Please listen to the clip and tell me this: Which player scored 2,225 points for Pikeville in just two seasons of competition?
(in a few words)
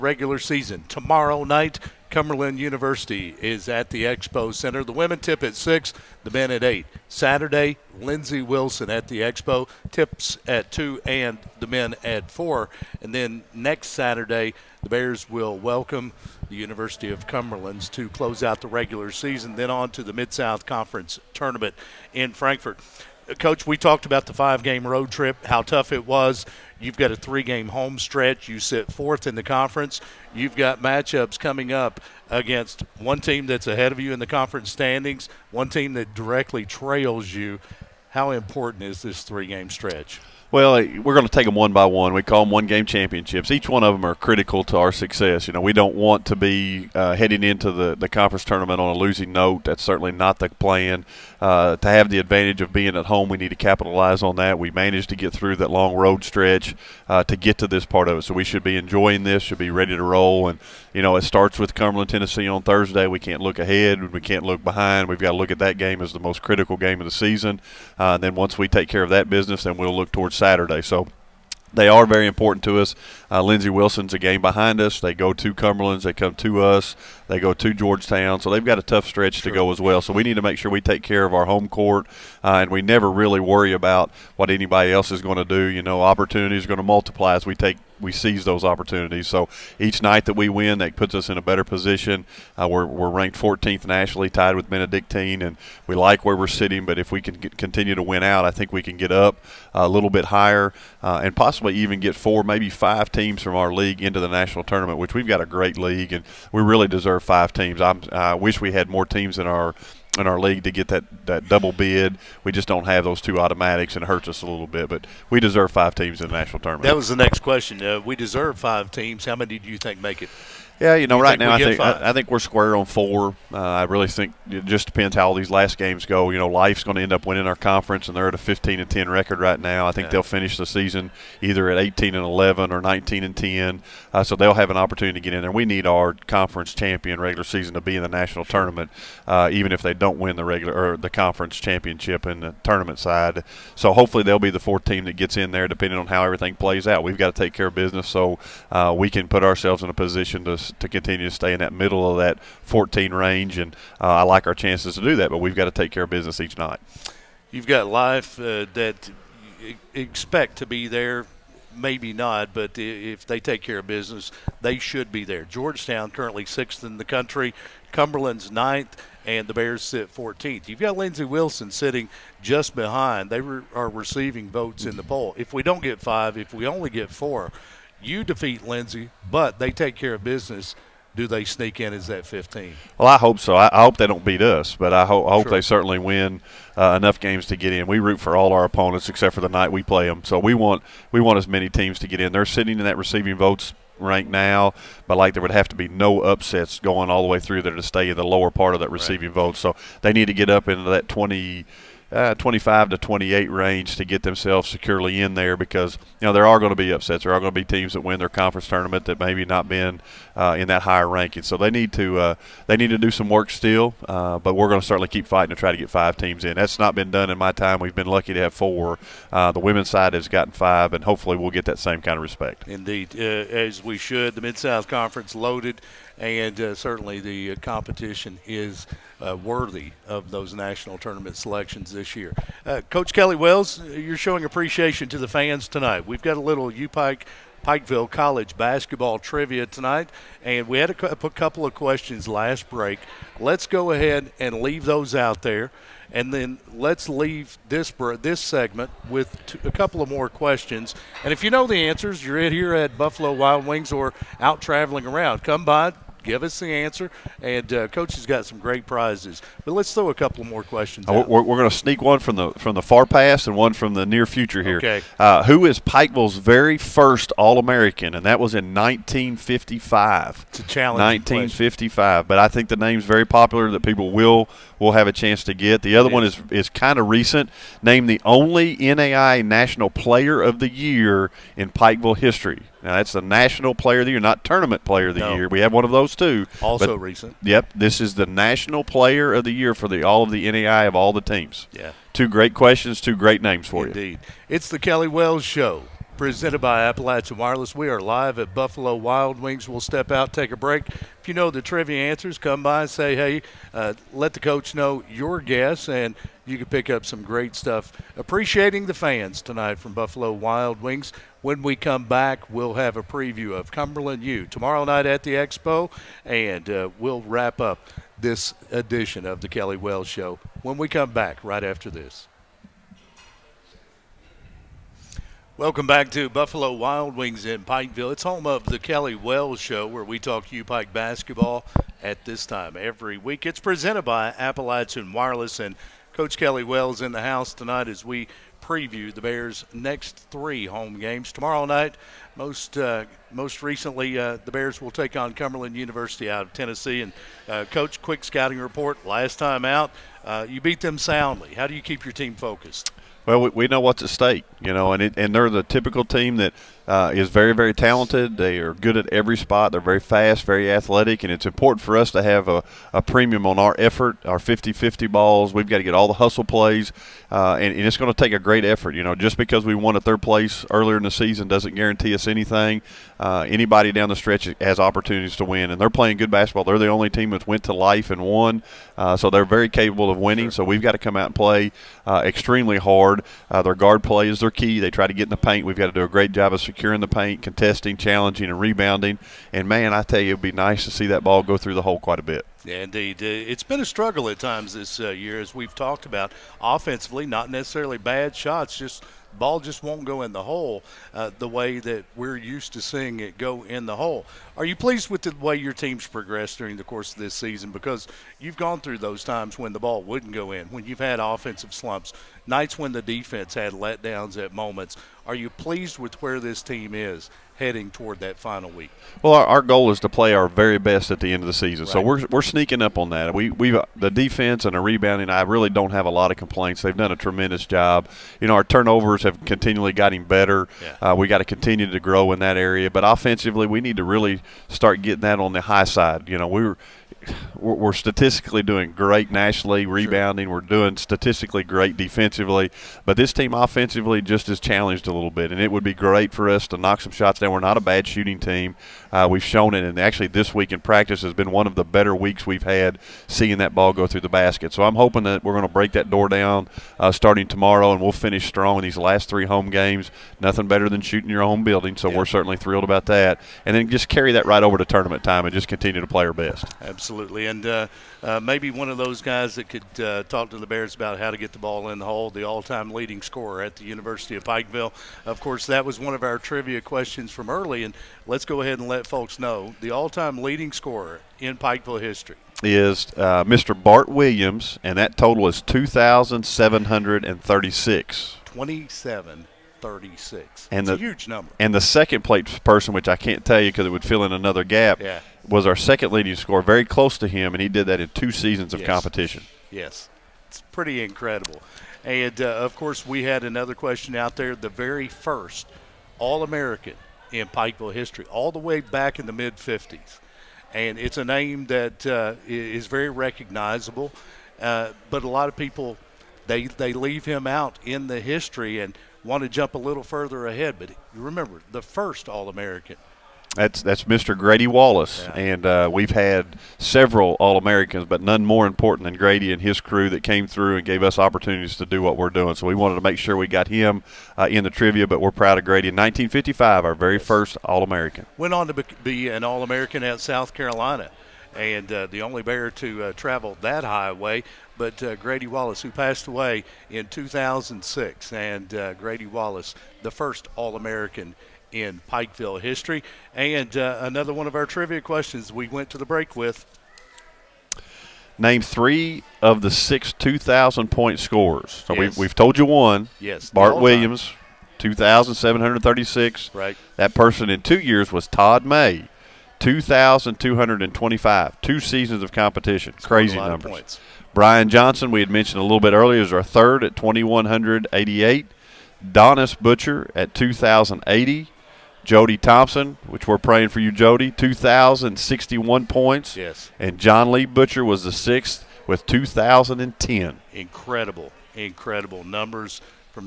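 Todd May.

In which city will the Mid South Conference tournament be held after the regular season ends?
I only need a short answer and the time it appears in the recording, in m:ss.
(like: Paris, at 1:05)
Frankfort, at 0:22.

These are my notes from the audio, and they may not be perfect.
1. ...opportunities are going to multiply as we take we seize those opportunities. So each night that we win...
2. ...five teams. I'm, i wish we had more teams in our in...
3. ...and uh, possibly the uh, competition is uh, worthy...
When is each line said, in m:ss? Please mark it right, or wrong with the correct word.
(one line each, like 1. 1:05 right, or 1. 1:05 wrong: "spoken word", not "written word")
1. 1:26 right
2. 1:47 right
3. 3:46 wrong: "certainly", not "possibly".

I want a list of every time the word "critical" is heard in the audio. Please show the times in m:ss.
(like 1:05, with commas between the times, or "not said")
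0:44, 1:06.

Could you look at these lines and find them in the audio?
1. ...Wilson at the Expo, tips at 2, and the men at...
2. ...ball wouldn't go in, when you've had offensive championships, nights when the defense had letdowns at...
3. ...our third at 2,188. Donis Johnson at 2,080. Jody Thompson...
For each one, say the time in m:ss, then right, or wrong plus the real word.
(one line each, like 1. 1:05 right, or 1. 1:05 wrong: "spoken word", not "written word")
1. 0:08 right
2. 6:49 wrong: "slumps", not "championships"
3. 9:36 wrong: "Butcher", not "Johnson".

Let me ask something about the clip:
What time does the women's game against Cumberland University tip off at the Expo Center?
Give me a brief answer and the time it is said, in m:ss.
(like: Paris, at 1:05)
6, at 0:04.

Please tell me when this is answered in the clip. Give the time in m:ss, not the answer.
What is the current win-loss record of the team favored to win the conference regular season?
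2:08.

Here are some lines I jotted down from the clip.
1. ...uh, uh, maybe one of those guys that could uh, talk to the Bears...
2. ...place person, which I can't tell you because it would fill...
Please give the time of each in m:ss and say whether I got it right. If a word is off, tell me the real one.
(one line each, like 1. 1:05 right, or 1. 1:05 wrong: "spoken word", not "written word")
1. 7:47 right
2. 8:12 right.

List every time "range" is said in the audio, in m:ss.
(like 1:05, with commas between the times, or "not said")
2:33, 3:23.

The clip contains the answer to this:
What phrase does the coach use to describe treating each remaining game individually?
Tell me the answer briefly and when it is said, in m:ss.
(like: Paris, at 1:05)
one game championships, at 0:42.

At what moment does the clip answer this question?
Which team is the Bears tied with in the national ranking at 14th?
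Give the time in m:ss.
1:34.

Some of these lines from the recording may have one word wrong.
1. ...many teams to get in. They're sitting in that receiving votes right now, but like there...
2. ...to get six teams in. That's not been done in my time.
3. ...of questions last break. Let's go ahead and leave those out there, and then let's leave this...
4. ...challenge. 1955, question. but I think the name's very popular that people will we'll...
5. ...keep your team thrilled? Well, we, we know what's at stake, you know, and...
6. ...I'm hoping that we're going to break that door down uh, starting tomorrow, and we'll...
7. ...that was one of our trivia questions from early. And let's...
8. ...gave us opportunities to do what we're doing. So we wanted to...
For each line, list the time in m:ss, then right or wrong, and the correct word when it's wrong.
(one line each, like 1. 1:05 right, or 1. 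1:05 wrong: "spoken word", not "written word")
1. 3:11 right
2. 3:35 wrong: "five", not "six"
3. 4:01 right
4. 4:30 right
5. 5:51 wrong: "focused", not "thrilled"
6. 7:34 right
7. 7:55 right
8. 8:50 right.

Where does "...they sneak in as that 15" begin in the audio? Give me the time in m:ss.
3:01.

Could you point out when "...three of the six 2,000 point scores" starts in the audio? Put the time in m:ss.
9:18.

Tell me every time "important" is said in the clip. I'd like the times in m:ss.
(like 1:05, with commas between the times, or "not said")
0:38, 1:12, 6:01, 8:48.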